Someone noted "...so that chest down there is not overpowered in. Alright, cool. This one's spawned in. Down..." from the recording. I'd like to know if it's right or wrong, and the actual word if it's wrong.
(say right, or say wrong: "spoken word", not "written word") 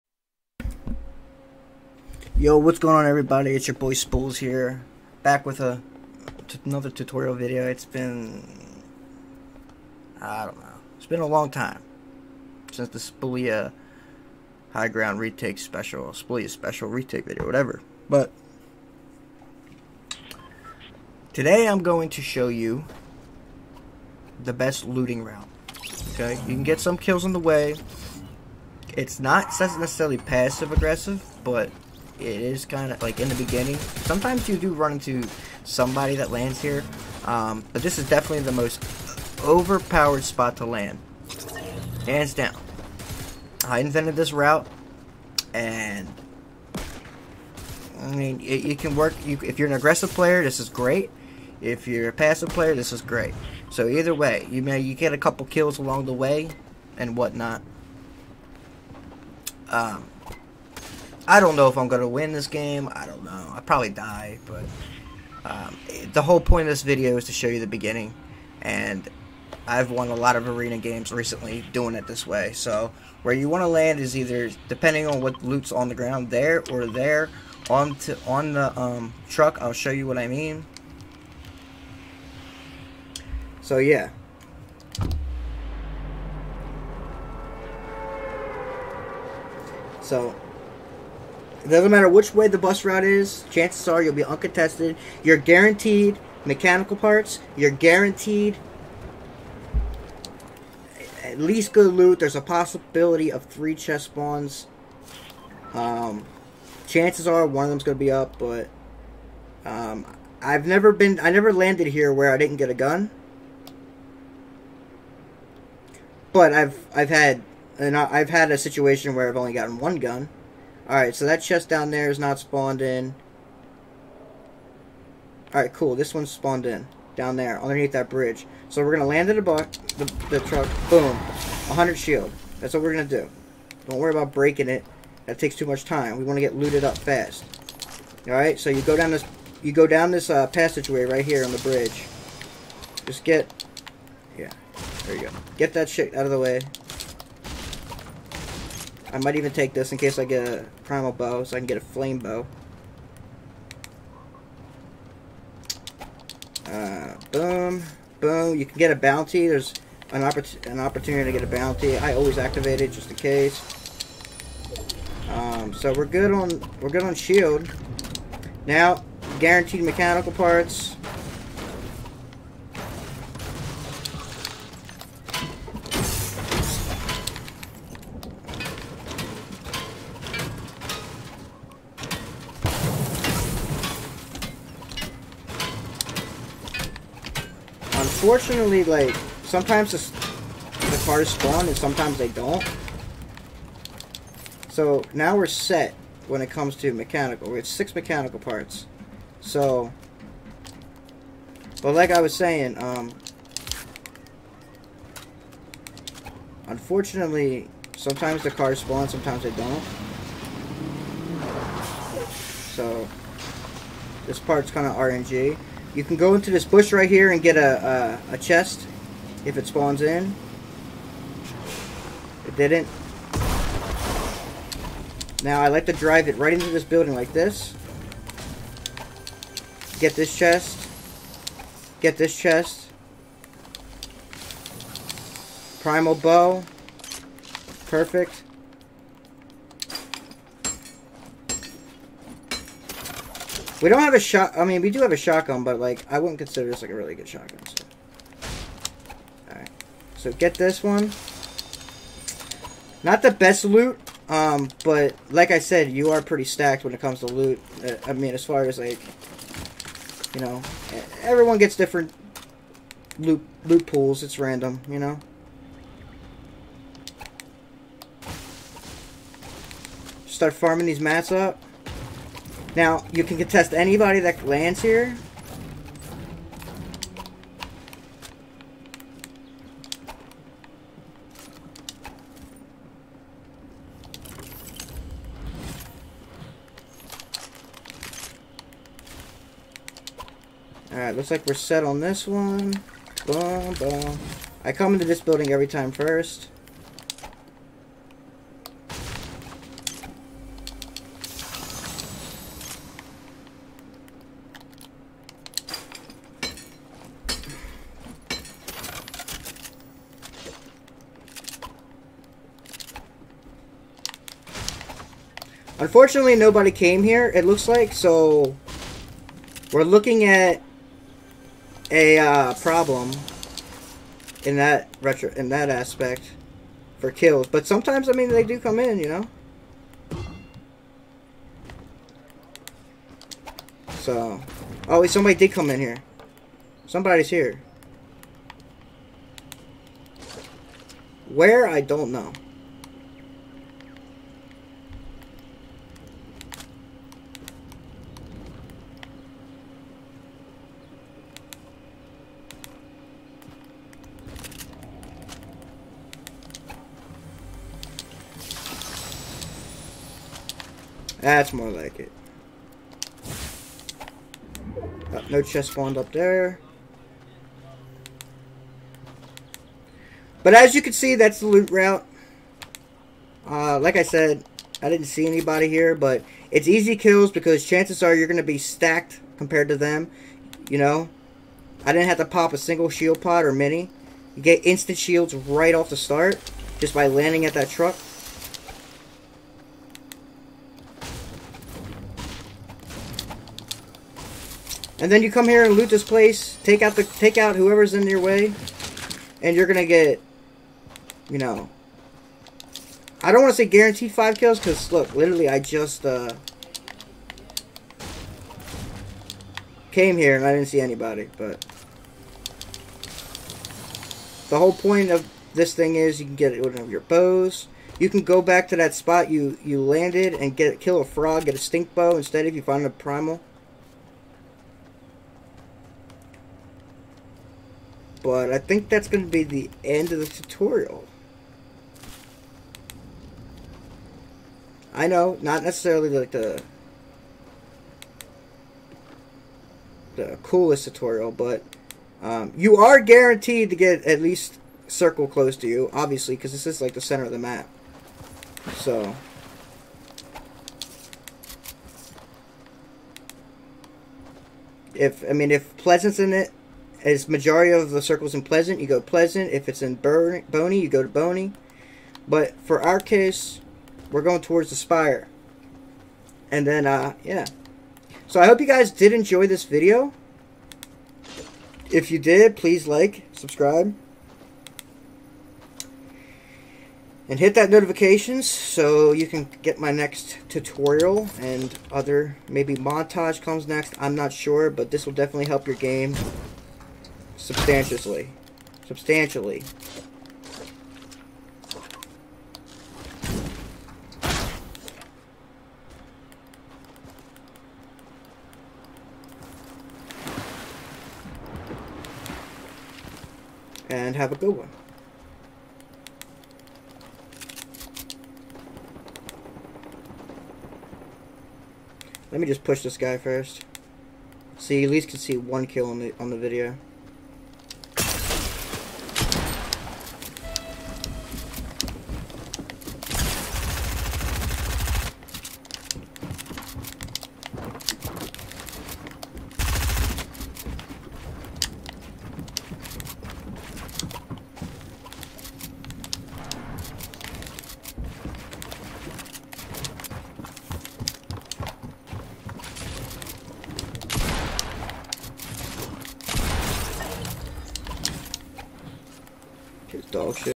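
wrong: "spawned", not "overpowered".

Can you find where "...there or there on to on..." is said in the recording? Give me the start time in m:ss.
1:16.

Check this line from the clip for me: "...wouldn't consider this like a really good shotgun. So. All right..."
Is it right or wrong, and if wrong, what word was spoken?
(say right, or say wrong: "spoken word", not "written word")
right.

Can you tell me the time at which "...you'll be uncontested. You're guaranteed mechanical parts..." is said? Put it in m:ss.
1:34.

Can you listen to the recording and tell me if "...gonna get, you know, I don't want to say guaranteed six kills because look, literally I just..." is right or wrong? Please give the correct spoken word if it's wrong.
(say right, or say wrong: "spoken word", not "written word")
wrong: "five", not "six".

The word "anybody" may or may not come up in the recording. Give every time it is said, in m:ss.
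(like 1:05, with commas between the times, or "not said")
4:33, 6:15, 6:50.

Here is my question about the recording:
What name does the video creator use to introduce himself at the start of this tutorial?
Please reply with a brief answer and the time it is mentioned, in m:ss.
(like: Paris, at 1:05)
Spools, at 0:03.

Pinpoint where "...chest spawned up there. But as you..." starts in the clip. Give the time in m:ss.
6:05.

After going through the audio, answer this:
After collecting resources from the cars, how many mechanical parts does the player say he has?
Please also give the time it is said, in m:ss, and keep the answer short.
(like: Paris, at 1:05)
6, at 3:17.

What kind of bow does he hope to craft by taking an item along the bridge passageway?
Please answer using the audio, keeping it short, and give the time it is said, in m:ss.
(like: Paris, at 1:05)
Flame bow, at 2:31.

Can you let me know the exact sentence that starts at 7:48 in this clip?
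So I hope you guys did enjoy this video.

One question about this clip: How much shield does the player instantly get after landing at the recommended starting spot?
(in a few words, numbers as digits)
100.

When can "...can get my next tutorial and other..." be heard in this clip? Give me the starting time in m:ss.
7:59.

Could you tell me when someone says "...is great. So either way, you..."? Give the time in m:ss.
0:52.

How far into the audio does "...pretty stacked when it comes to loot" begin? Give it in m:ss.
4:16.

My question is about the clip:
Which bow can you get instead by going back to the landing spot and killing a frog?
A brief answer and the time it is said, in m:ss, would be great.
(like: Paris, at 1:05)
Stink bow, at 7:01.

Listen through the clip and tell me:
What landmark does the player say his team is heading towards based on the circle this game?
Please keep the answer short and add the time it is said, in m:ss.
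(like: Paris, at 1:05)
The spire, at 7:44.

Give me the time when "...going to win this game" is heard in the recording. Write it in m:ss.
1:01.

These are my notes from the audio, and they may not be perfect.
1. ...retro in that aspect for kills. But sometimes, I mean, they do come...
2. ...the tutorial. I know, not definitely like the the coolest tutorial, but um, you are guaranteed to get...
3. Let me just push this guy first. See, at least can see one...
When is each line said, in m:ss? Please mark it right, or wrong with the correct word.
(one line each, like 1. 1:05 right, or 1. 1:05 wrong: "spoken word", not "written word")
1. 5:25 right
2. 7:10 wrong: "necessarily", not "definitely"
3. 8:32 right.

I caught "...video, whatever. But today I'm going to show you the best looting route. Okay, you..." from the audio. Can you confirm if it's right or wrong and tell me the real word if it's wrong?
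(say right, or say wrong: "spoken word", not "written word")
right.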